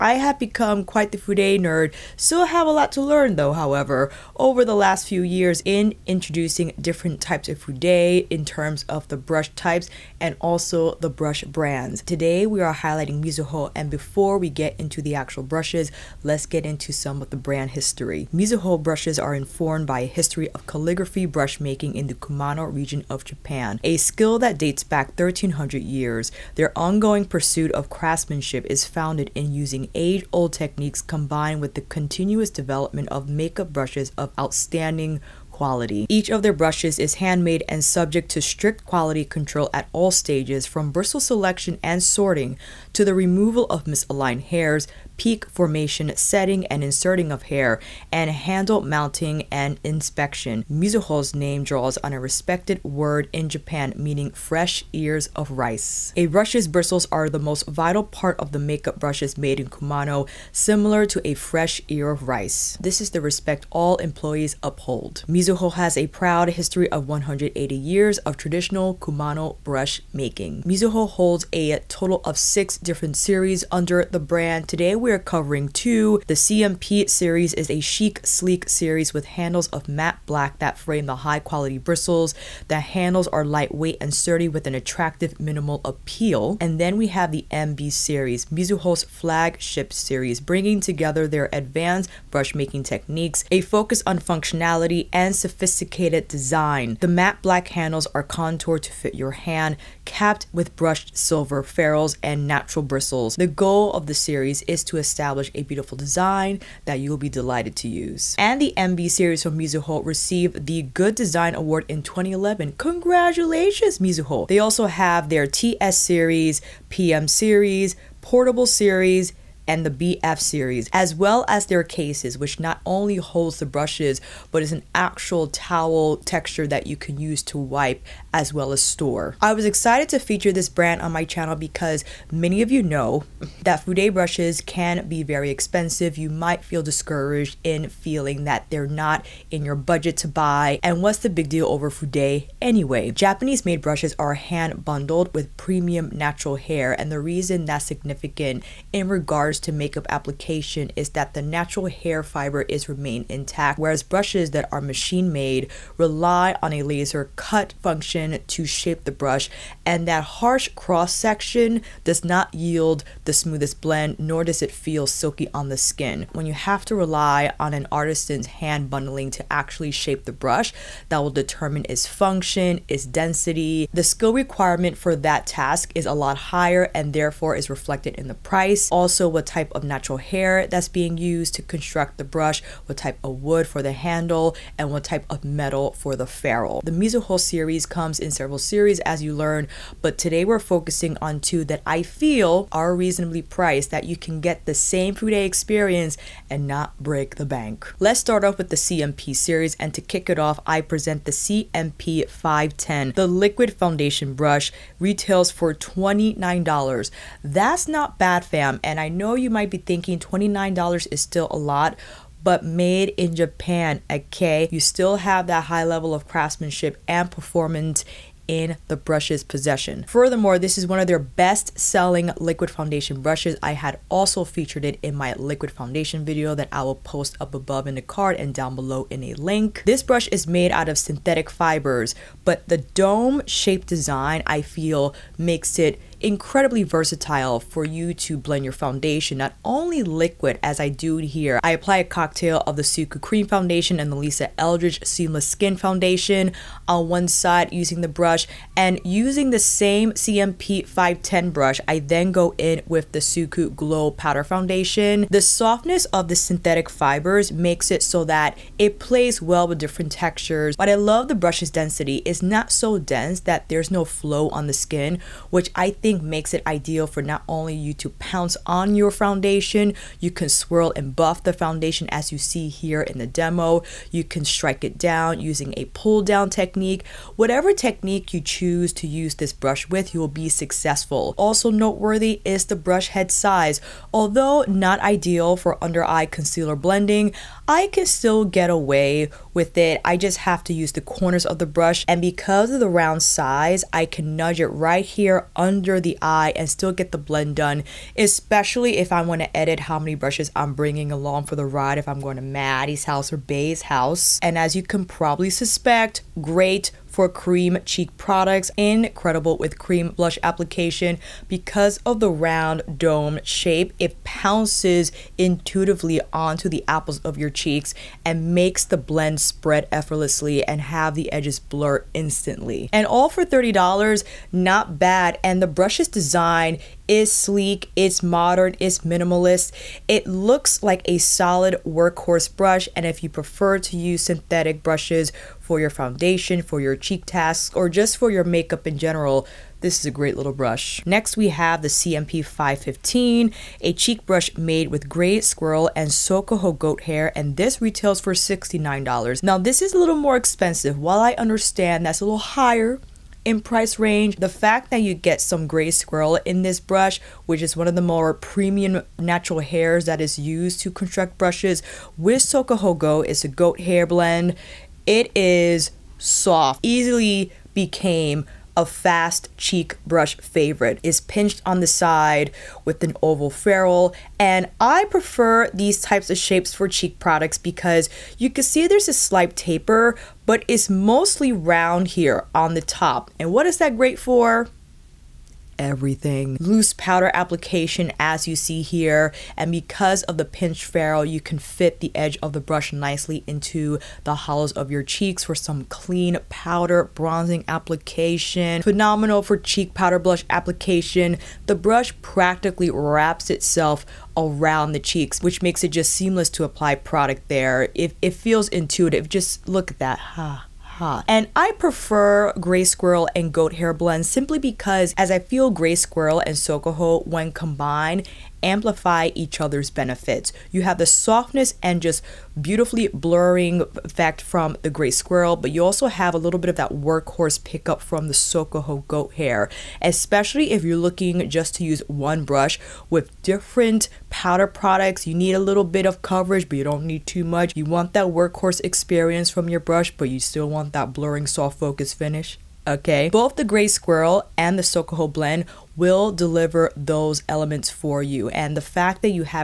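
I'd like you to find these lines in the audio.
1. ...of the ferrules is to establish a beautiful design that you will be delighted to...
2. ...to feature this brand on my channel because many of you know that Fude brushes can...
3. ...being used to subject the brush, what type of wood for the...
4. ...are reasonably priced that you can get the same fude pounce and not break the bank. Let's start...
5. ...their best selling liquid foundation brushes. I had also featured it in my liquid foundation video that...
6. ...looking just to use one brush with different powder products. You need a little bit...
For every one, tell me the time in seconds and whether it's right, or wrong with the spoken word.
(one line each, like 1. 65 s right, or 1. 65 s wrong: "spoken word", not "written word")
1. 103 s wrong: "series", not "ferrules"
2. 130 s right
3. 180 s wrong: "construct", not "subject"
4. 192 s wrong: "experience", not "pounce"
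5. 221 s right
6. 430 s right.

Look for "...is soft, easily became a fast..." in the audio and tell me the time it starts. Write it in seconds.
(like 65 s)
365 s.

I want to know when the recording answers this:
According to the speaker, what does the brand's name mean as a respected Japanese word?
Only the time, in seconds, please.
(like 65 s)
54 s.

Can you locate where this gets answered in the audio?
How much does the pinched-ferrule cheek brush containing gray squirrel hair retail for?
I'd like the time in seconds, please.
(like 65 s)
348 s.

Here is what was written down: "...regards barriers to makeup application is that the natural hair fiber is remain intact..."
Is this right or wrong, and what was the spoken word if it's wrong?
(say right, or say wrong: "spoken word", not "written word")
right.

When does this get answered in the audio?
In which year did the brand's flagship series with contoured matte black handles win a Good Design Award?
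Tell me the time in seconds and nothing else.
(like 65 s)
112 s.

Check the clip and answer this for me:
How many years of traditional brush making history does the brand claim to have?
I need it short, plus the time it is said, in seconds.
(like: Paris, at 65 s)
180 years, at 67 s.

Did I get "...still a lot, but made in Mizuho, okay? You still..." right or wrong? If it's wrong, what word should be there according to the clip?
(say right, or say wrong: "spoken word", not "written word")
wrong: "Japan", not "Mizuho".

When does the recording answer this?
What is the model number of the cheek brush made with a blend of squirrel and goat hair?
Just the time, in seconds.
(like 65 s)
341 s.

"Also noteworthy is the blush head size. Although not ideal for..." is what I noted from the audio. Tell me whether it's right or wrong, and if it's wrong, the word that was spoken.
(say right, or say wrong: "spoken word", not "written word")
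wrong: "brush", not "blush".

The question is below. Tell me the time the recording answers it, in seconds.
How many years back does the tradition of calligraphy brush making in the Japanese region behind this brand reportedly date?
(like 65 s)
25 s.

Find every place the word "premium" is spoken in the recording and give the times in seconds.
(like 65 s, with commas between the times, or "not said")
145 s, 358 s.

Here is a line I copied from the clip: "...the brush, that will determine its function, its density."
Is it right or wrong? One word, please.
right.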